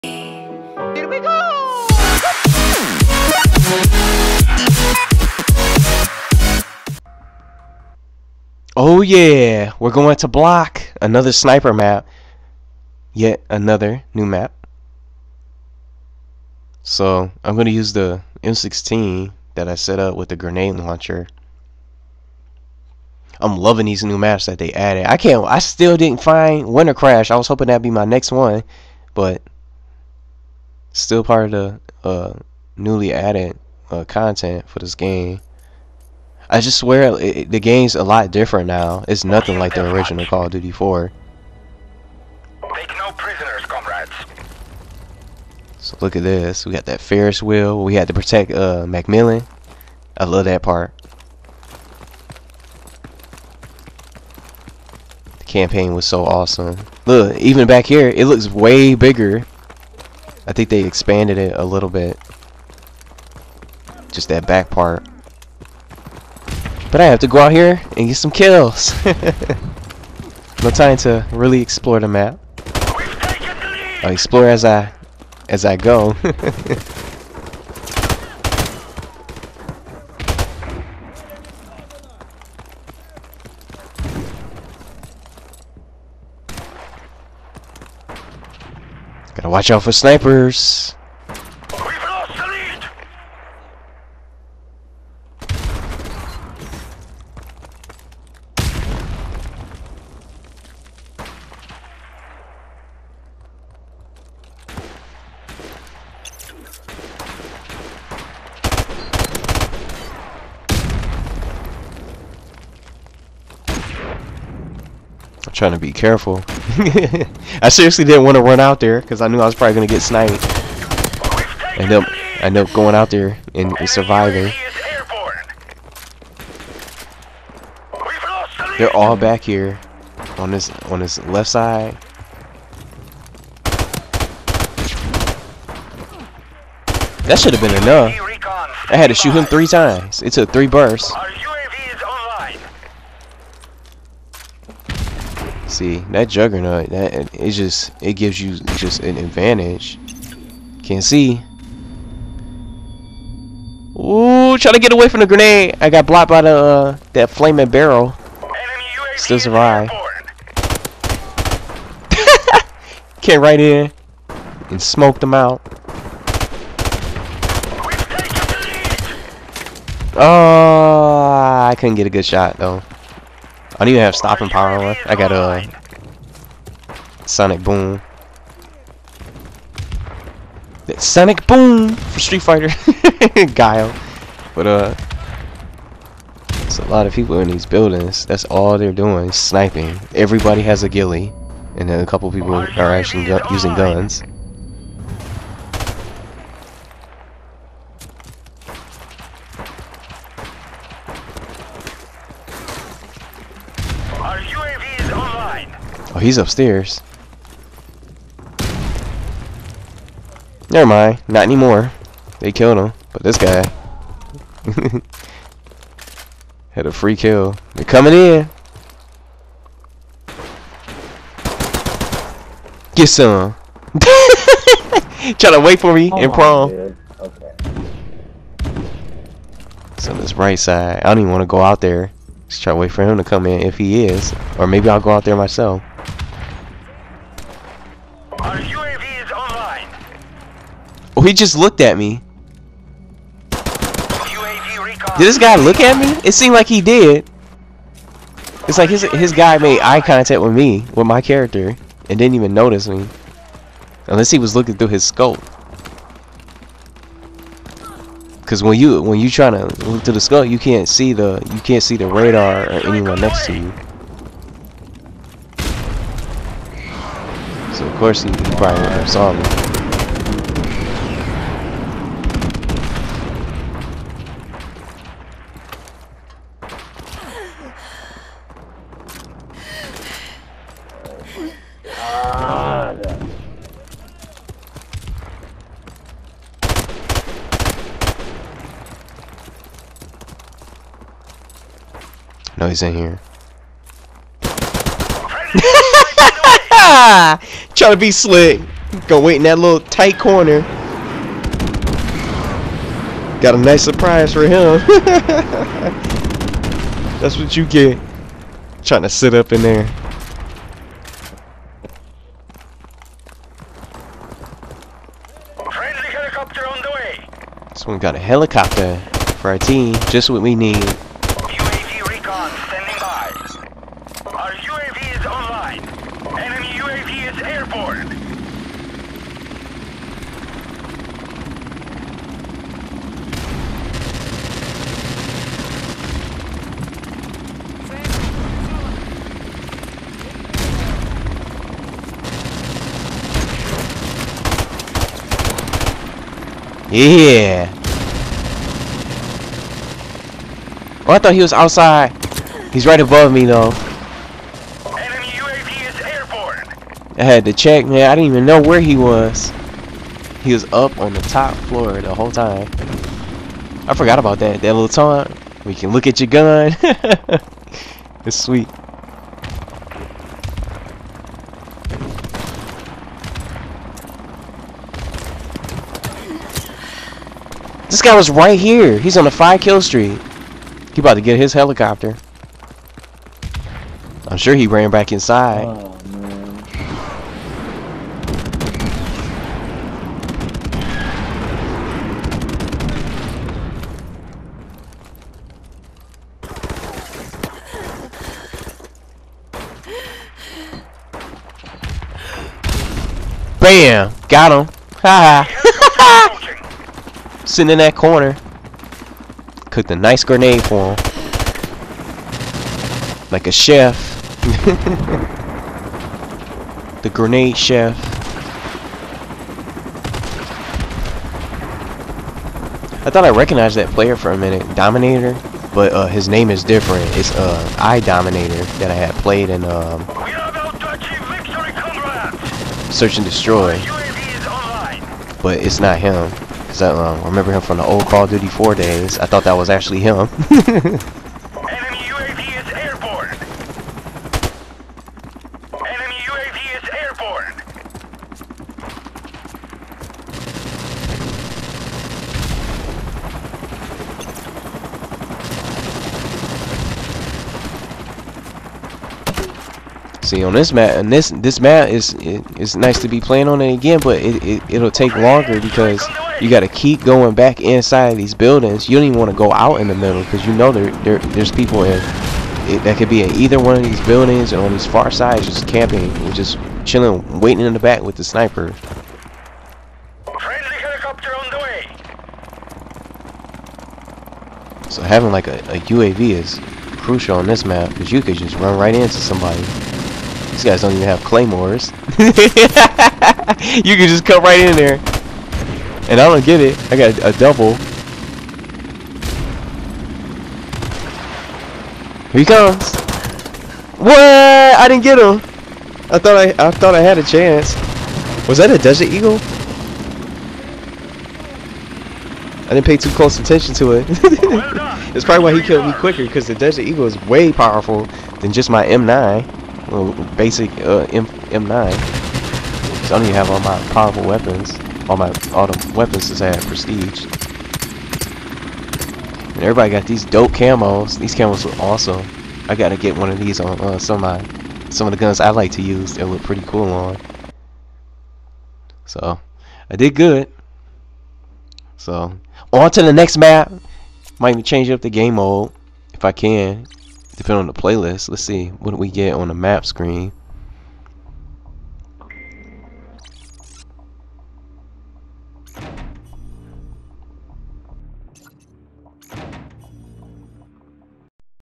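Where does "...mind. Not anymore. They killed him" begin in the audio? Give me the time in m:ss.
3:30.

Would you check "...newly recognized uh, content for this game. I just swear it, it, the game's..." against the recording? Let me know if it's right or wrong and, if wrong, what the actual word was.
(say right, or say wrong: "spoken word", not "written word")
wrong: "added", not "recognized".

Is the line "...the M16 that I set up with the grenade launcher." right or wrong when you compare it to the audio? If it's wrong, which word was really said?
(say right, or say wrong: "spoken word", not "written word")
right.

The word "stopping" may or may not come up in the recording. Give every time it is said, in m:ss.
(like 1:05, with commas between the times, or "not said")
2:54.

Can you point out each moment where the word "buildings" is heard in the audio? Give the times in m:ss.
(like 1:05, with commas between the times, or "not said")
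3:07, 7:48, 7:54.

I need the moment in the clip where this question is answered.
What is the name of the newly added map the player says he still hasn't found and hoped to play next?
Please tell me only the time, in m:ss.
0:26.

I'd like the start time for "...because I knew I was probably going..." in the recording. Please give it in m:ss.
1:58.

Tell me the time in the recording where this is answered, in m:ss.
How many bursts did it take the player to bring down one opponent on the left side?
2:20.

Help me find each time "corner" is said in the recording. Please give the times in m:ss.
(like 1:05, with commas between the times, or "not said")
5:00, 6:47.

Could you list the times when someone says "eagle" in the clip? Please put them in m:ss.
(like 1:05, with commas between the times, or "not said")
8:29, 8:36.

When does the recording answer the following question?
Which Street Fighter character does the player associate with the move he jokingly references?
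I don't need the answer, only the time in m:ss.
3:03.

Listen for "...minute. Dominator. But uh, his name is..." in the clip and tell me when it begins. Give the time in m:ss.
7:04.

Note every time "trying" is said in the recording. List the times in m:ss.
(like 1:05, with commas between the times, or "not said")
1:55, 2:34, 4:19, 4:57, 5:08.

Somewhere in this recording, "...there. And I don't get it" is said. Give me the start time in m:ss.
8:14.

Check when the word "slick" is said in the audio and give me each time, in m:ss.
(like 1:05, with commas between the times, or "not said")
4:58.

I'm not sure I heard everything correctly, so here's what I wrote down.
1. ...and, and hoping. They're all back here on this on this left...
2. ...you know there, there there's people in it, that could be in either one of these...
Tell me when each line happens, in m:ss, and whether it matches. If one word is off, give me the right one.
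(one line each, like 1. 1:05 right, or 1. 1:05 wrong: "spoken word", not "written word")
1. 2:03 wrong: "surviving", not "hoping"
2. 7:50 right.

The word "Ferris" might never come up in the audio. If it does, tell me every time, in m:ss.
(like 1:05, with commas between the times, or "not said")
0:46.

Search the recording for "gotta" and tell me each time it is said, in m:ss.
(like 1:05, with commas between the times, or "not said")
1:29, 8:52.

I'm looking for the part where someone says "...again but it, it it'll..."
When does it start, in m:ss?
7:43.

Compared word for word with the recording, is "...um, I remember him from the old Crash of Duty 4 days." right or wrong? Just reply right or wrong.
wrong.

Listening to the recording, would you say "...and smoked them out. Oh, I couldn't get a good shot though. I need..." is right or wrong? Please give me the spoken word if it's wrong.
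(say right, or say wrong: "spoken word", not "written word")
right.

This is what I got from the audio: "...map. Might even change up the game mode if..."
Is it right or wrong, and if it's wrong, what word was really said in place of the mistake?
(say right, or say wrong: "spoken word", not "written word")
right.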